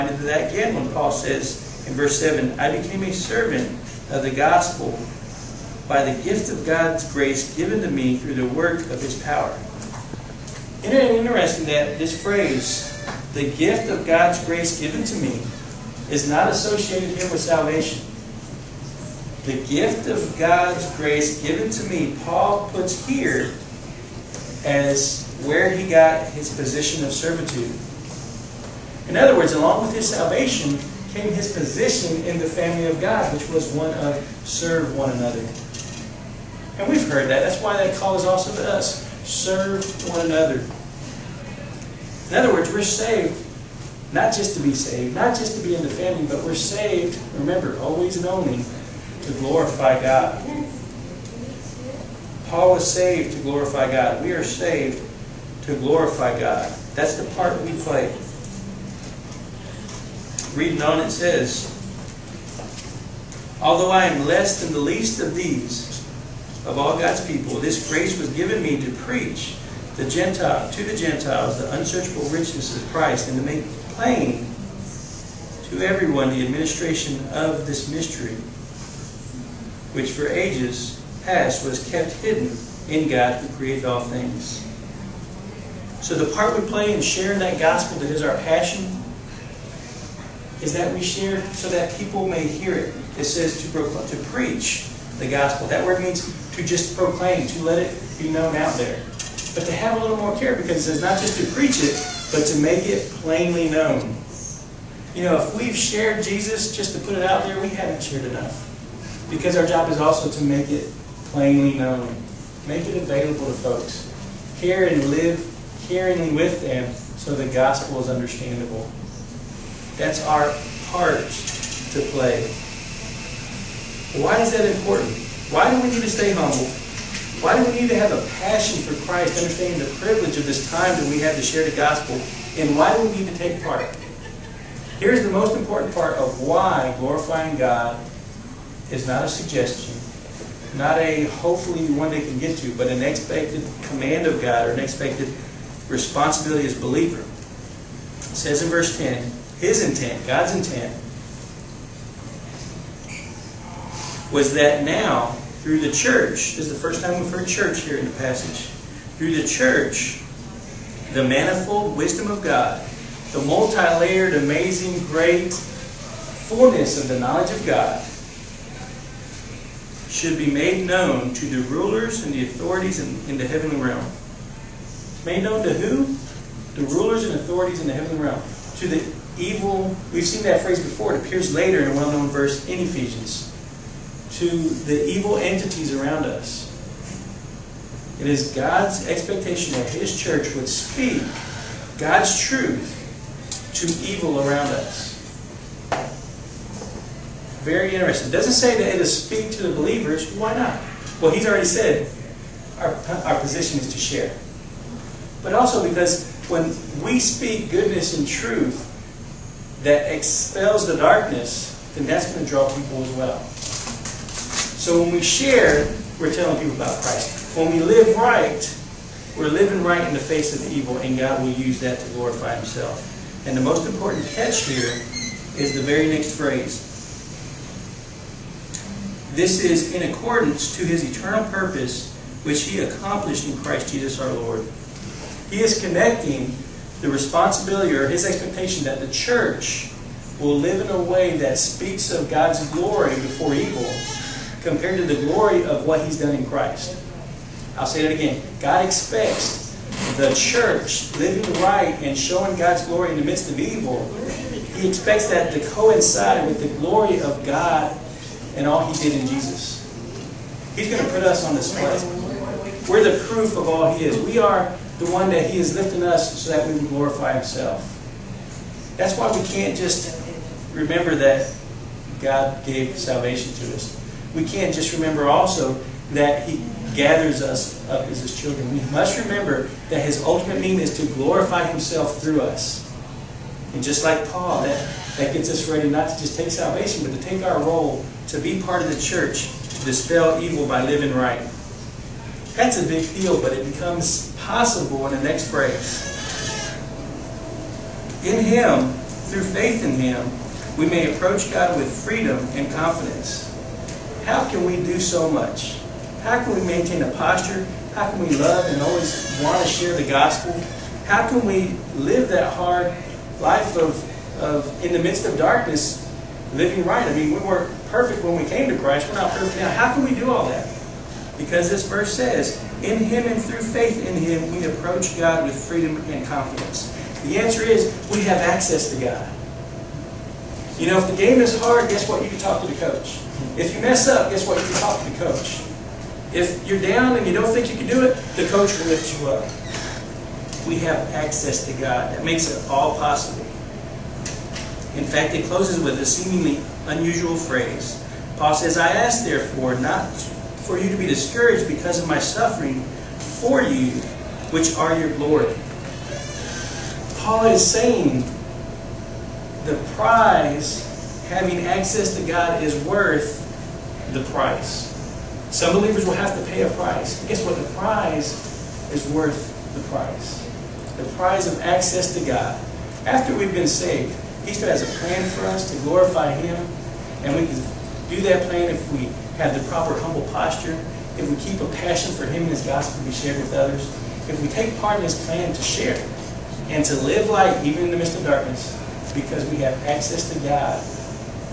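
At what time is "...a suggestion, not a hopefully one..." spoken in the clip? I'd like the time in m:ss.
2:19.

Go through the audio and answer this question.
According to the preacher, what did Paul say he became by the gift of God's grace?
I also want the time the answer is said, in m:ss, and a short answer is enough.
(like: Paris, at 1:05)
A servant of the gospel, at 0:03.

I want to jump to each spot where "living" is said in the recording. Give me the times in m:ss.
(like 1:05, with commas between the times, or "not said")
3:39, 4:11, 4:50, 5:16.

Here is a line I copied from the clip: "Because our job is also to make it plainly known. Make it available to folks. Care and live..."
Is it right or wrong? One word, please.
right.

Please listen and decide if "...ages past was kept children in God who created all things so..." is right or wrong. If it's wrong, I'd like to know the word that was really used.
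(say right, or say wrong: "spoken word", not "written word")
wrong: "hidden", not "children".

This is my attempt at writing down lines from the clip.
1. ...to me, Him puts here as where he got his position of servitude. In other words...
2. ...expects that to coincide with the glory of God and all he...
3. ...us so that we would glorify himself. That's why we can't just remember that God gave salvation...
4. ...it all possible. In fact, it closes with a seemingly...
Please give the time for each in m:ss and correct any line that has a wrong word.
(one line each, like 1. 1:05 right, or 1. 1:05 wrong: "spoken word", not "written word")
1. 0:21 wrong: "Paul", not "Him"
2. 4:14 right
3. 4:26 right
4. 5:42 right.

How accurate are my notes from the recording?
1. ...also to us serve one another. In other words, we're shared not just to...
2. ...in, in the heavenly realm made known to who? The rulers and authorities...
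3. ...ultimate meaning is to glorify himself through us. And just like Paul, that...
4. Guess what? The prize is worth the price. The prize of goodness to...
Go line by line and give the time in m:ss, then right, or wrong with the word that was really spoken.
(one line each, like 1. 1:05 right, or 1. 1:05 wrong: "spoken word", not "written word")
1. 0:38 wrong: "saved", not "shared"
2. 2:52 right
3. 4:40 right
4. 6:07 wrong: "access", not "goodness".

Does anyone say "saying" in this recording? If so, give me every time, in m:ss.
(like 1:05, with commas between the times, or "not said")
5:57.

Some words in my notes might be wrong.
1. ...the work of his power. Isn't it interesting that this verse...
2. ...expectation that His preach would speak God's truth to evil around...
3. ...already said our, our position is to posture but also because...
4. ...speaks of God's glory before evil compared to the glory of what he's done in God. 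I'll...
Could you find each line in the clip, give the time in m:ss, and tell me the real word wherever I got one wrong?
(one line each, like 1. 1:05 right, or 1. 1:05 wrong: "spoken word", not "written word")
1. 0:08 wrong: "phrase", not "verse"
2. 3:09 wrong: "church", not "preach"
3. 3:21 wrong: "share", not "posture"
4. 4:01 wrong: "Christ", not "God".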